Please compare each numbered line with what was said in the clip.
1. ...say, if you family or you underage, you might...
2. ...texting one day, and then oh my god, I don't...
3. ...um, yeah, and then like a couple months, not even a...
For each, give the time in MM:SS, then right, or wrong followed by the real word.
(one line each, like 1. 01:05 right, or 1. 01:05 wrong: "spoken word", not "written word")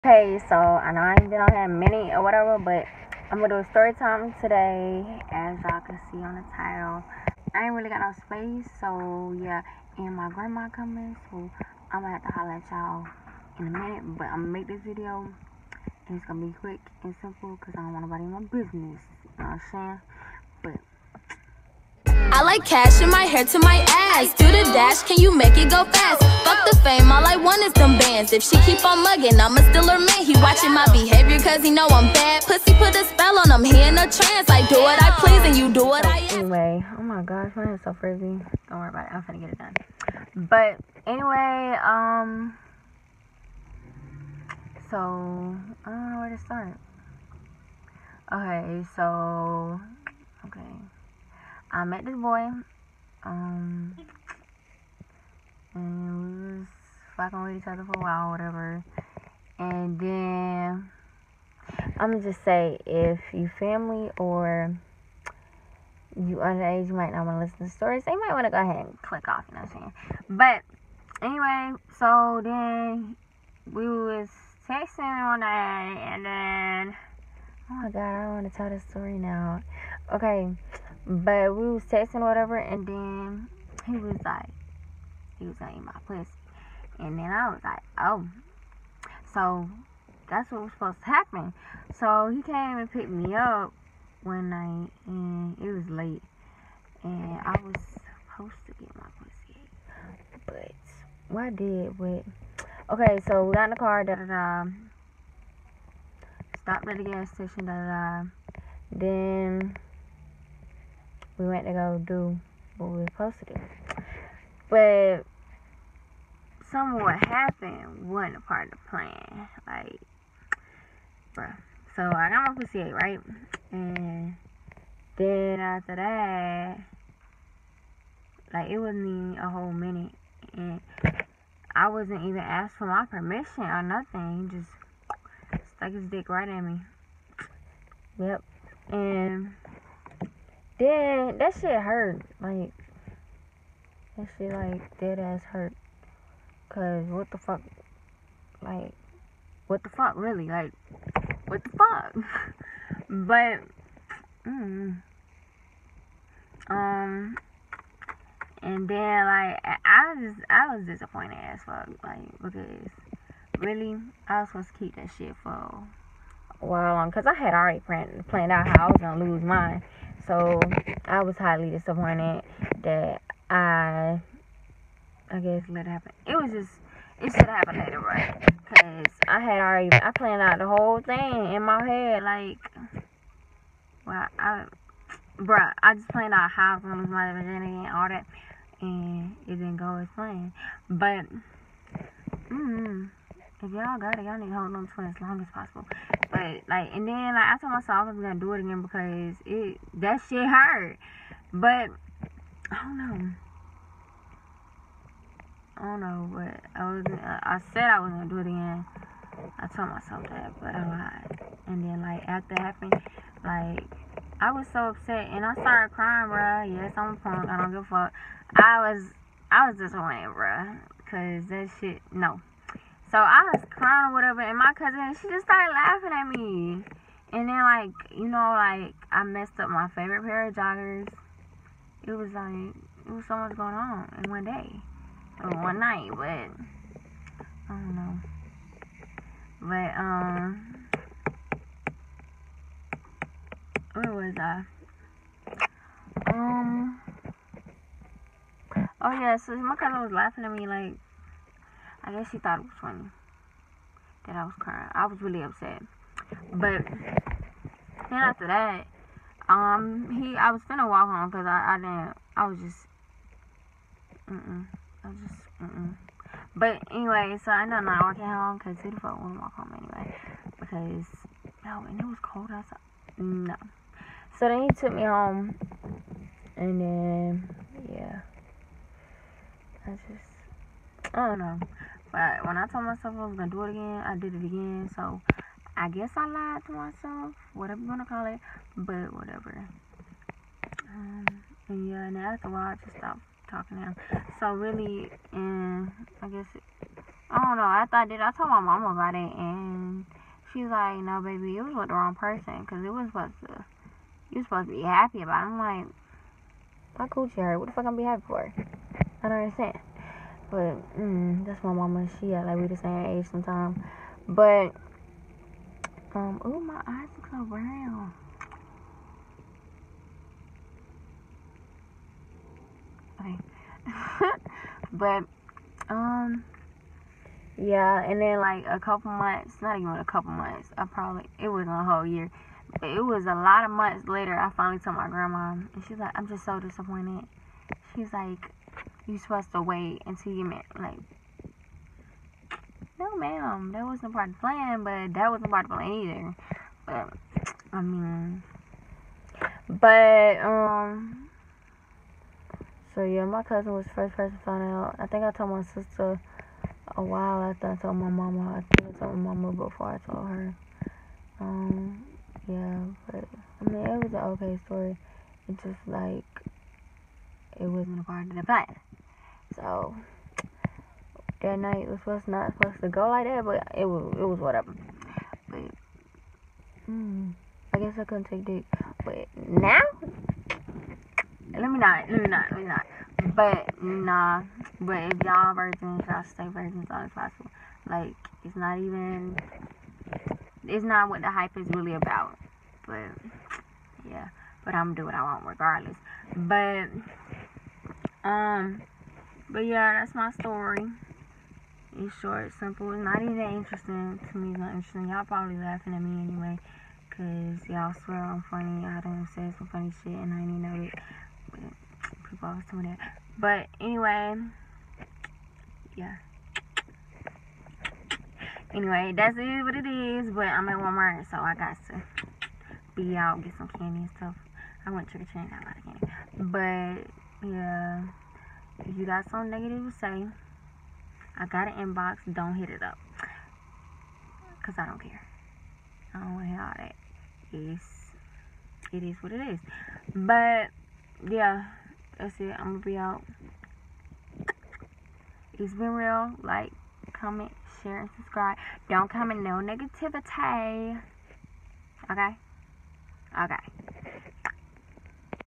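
1. 01:02 right
2. 01:14 right
3. 05:25 right.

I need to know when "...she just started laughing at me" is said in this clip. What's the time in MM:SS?
03:45.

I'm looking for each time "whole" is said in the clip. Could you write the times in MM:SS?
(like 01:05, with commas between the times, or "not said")
02:09, 03:00, 05:31.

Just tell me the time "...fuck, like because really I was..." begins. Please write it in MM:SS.
02:41.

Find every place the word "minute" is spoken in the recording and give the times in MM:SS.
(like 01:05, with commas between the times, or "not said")
00:13, 02:09.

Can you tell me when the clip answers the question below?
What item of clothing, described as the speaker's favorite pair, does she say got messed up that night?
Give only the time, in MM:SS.
03:50.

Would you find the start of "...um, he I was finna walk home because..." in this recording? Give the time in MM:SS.
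04:19.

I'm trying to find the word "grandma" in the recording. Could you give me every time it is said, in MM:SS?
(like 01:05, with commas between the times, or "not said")
00:10, 05:35.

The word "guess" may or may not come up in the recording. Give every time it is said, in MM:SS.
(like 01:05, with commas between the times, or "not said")
02:55, 04:12, 04:45, 04:56, 06:17.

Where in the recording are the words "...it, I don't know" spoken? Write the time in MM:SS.
04:56.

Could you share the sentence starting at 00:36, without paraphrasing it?
Anyway, oh my gosh, mine is so frizzy.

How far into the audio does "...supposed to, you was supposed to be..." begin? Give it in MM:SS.
05:03.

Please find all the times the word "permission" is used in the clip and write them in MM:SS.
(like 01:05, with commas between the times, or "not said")
02:13.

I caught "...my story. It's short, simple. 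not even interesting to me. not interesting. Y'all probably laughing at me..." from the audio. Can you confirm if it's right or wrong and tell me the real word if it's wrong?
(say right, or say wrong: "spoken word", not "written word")
right.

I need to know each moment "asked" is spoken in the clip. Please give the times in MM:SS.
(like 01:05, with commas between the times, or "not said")
02:12.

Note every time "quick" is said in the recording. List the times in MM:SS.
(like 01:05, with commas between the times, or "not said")
00:16.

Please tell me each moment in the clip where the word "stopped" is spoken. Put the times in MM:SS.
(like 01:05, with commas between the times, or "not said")
01:46, 04:52.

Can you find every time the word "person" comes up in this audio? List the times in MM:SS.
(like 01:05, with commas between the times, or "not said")
05:02, 05:54.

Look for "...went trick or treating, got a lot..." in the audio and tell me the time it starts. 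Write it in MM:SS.
07:04.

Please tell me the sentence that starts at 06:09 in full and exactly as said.
So that night was supposed not supposed to go like that, but it was it was whatever.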